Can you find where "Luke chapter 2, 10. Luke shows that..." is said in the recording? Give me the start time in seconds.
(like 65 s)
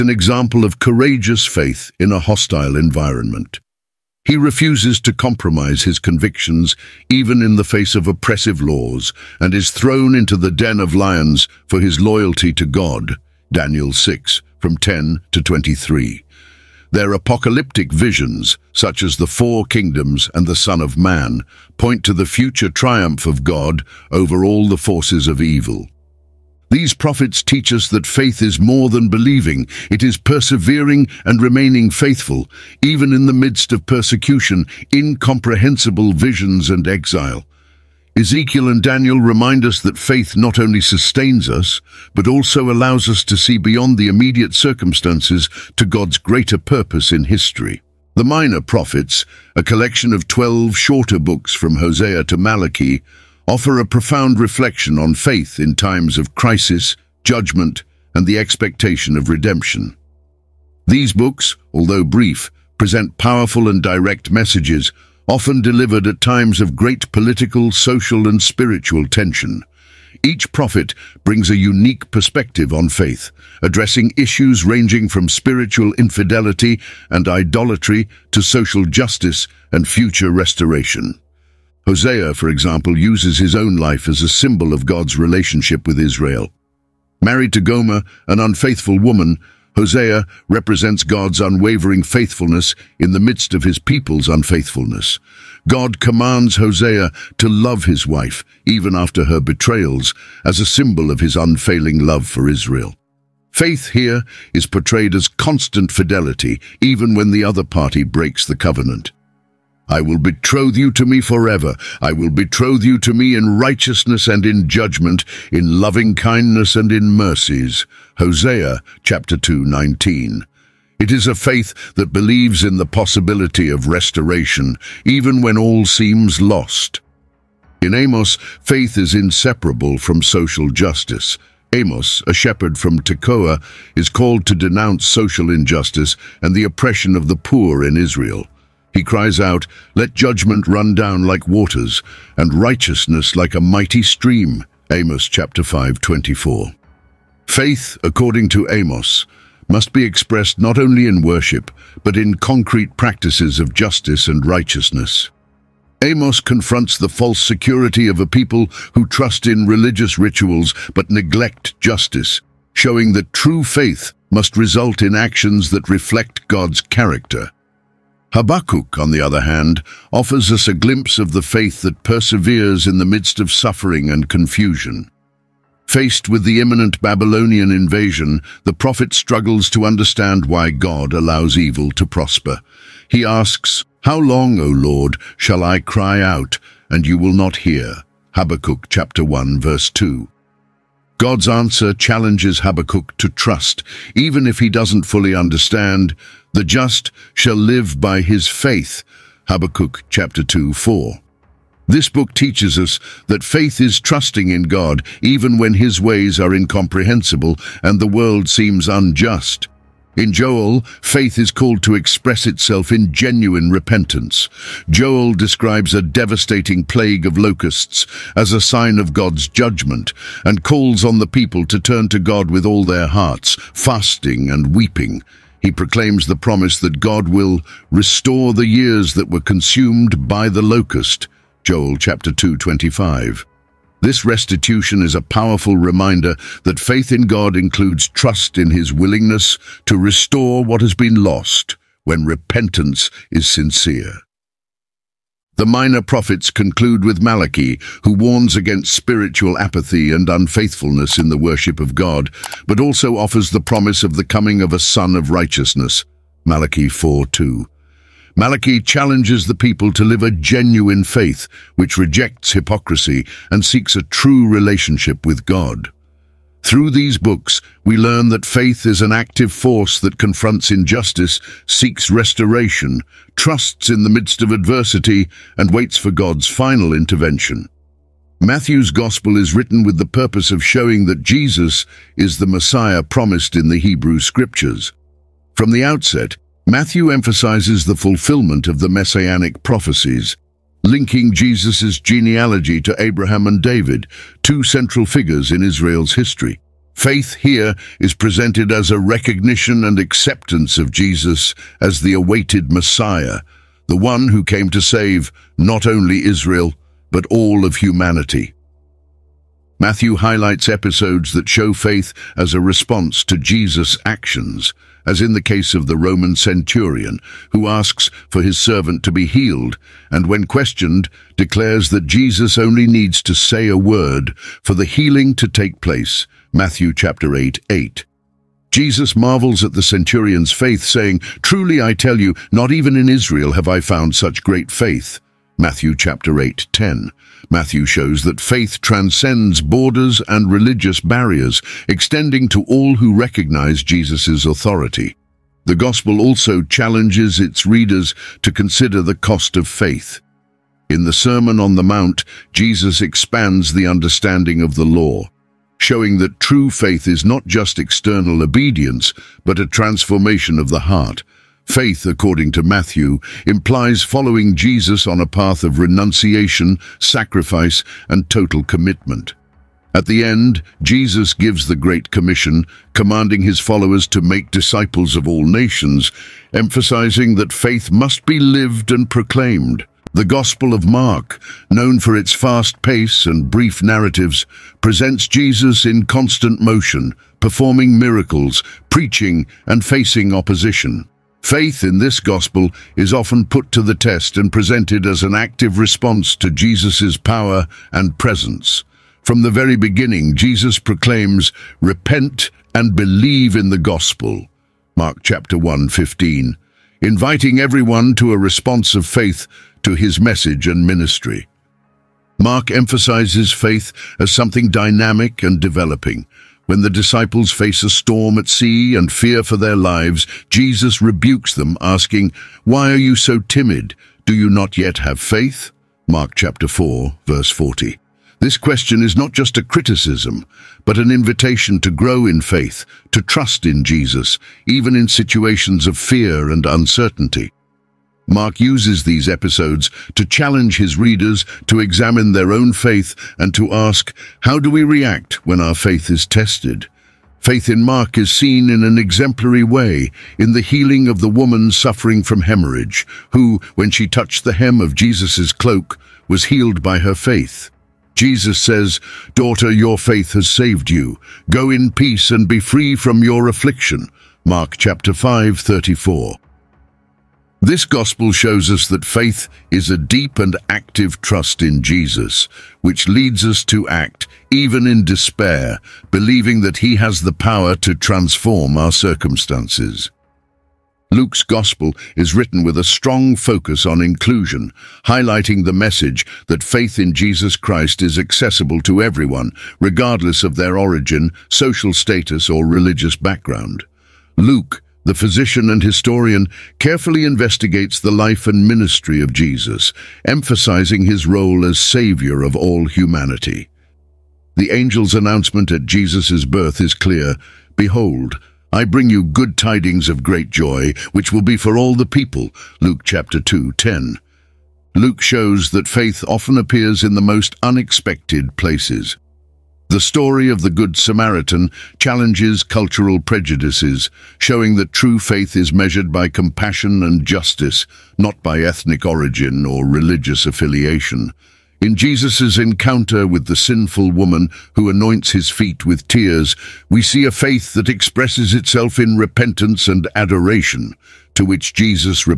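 512 s.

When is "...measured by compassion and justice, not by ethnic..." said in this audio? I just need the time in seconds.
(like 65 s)
525 s.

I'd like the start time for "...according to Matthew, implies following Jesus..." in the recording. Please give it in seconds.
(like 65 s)
362 s.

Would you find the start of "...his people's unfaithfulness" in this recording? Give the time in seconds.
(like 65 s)
93 s.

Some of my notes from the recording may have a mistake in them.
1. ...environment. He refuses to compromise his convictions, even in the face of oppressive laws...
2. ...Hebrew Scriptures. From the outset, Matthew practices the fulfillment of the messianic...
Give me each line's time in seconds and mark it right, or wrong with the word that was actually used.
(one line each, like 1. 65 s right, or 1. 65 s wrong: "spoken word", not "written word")
1. 2 s right
2. 283 s wrong: "emphasizes", not "practices".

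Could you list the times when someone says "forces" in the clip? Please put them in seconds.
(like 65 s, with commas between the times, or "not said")
24 s, 269 s.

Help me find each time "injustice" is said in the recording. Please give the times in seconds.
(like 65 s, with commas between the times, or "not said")
135 s, 270 s.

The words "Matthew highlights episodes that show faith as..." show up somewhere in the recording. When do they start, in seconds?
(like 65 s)
309 s.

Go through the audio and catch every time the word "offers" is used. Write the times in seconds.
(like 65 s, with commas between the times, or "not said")
53 s, 170 s, 253 s.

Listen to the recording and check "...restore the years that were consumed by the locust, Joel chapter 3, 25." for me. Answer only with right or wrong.
wrong.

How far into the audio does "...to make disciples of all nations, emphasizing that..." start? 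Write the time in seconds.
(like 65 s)
374 s.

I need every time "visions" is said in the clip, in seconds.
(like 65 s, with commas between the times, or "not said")
17 s, 36 s.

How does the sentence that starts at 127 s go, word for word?
In Amos, faith is inseparable from social justice.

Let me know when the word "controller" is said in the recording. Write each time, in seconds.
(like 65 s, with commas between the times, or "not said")
not said.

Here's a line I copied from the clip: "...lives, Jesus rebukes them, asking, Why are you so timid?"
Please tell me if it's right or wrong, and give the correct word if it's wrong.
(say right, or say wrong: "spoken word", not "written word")
right.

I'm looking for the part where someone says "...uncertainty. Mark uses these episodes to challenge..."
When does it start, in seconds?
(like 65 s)
436 s.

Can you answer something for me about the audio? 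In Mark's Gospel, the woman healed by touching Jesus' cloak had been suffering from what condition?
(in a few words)
Hemorrhage.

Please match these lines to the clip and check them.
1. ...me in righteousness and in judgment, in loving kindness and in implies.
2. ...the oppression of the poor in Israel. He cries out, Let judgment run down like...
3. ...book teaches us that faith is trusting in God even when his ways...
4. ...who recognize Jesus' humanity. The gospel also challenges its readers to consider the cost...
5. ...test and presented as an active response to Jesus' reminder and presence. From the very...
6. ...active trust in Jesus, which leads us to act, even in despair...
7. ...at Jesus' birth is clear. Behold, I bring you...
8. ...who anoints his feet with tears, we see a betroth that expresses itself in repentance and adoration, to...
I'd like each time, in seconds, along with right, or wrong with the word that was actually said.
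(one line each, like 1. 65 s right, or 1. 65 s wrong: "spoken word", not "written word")
1. 113 s wrong: "mercies", not "implies"
2. 136 s right
3. 202 s right
4. 342 s wrong: "authority", not "humanity"
5. 393 s wrong: "power", not "reminder"
6. 470 s right
7. 505 s right
8. 534 s wrong: "faith", not "betroth".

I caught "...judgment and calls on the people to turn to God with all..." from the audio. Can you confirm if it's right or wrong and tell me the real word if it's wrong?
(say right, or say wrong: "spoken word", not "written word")
right.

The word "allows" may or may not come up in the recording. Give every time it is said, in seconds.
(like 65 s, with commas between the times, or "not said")
42 s, 181 s.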